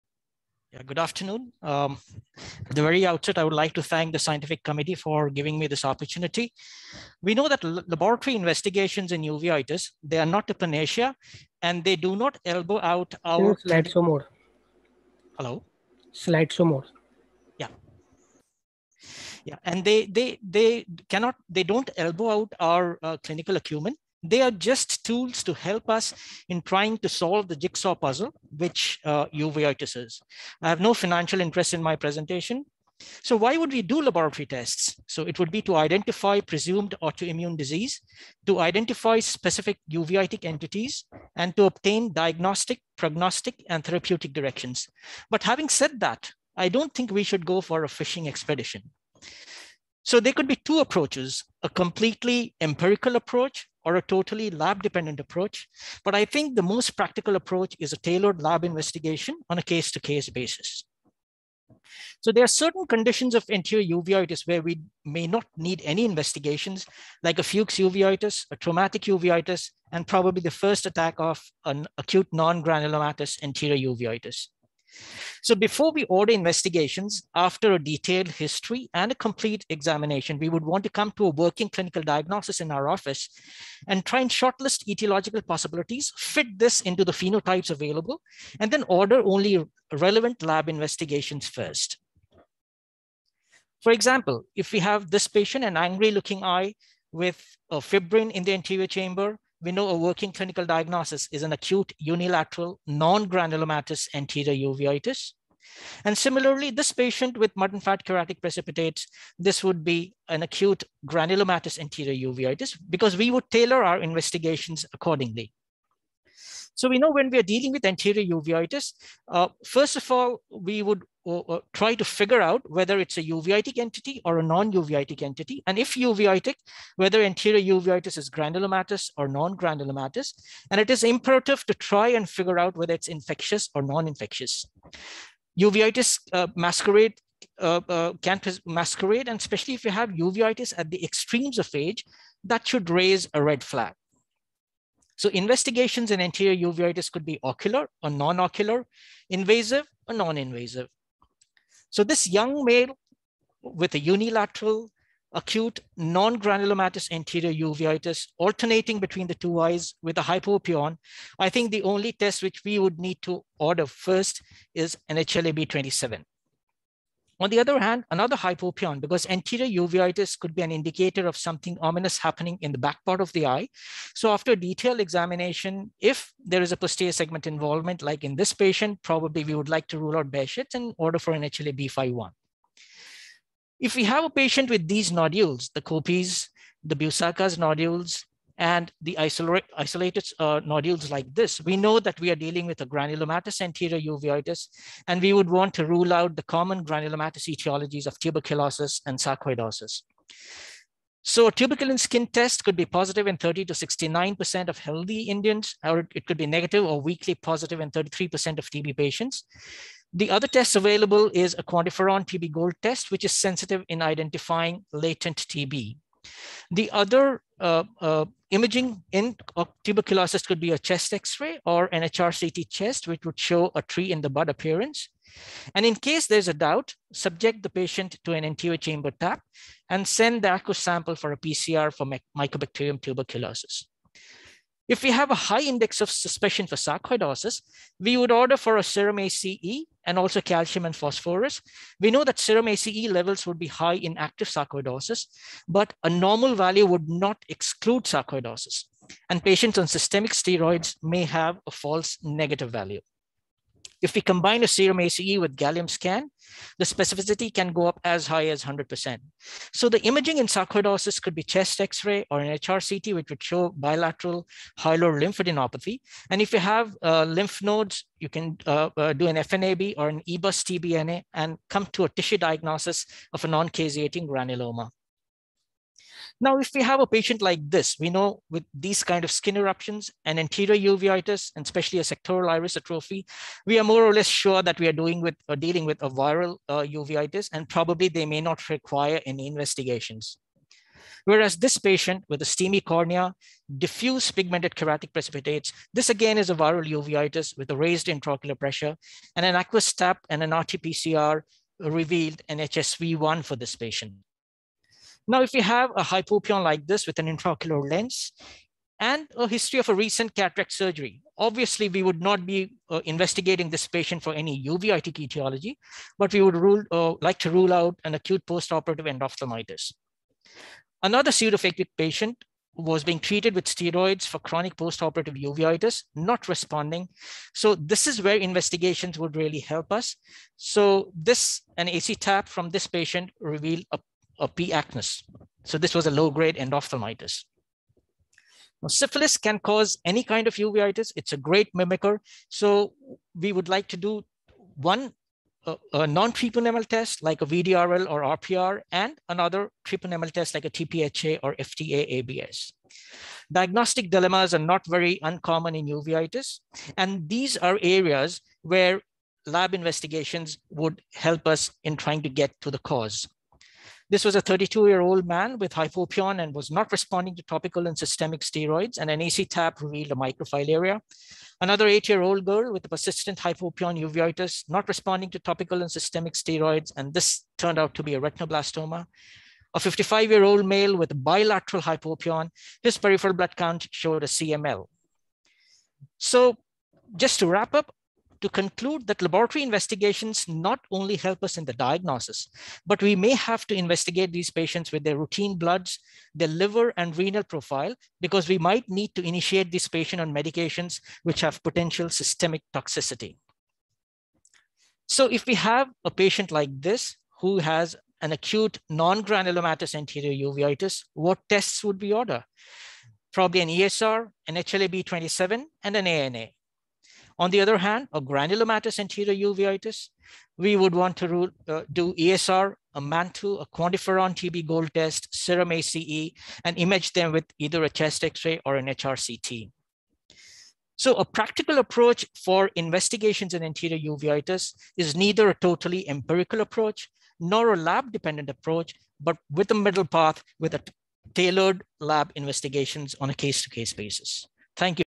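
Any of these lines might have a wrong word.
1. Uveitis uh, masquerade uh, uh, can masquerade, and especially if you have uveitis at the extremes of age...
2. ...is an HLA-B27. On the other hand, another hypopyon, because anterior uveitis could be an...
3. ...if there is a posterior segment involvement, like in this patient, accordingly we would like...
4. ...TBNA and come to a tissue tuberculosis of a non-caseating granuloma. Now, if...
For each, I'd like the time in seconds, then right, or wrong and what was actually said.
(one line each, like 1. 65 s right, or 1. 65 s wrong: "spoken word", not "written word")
1. 135 s right
2. 164 s right
3. 175 s wrong: "probably", not "accordingly"
4. 270 s wrong: "diagnosis", not "tuberculosis".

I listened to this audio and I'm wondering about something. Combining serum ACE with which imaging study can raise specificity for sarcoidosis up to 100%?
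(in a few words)
Gallium scan.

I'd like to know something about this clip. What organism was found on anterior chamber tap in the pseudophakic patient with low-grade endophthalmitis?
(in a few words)
P. acnes.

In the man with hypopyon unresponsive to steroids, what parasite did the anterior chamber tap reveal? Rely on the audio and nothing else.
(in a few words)
Microfilaria.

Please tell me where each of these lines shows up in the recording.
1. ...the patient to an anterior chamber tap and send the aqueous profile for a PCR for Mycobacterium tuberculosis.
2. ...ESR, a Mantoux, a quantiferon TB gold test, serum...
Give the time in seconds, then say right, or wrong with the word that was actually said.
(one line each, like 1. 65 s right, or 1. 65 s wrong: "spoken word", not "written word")
1. 227 s wrong: "sample", not "profile"
2. 422 s right.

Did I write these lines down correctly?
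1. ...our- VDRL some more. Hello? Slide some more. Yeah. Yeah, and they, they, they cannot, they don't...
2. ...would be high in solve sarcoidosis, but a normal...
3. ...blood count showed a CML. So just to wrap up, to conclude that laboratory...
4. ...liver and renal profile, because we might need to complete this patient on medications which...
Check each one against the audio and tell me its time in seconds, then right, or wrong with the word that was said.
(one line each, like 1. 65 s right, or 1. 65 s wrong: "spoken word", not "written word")
1. 13 s wrong: "Slide", not "VDRL"
2. 243 s wrong: "active", not "solve"
3. 383 s right
4. 396 s wrong: "initiate", not "complete".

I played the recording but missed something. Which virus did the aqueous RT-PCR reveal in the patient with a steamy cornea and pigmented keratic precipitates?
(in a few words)
HSV1.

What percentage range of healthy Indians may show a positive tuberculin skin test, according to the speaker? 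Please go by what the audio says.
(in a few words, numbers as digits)
30 to 69%.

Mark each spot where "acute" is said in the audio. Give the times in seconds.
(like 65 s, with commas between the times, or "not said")
71 s, 101 s, 110 s, 155 s, 318 s, 408 s.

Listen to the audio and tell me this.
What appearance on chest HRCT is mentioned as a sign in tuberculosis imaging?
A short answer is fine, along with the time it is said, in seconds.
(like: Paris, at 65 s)
Tree in the bud, at 223 s.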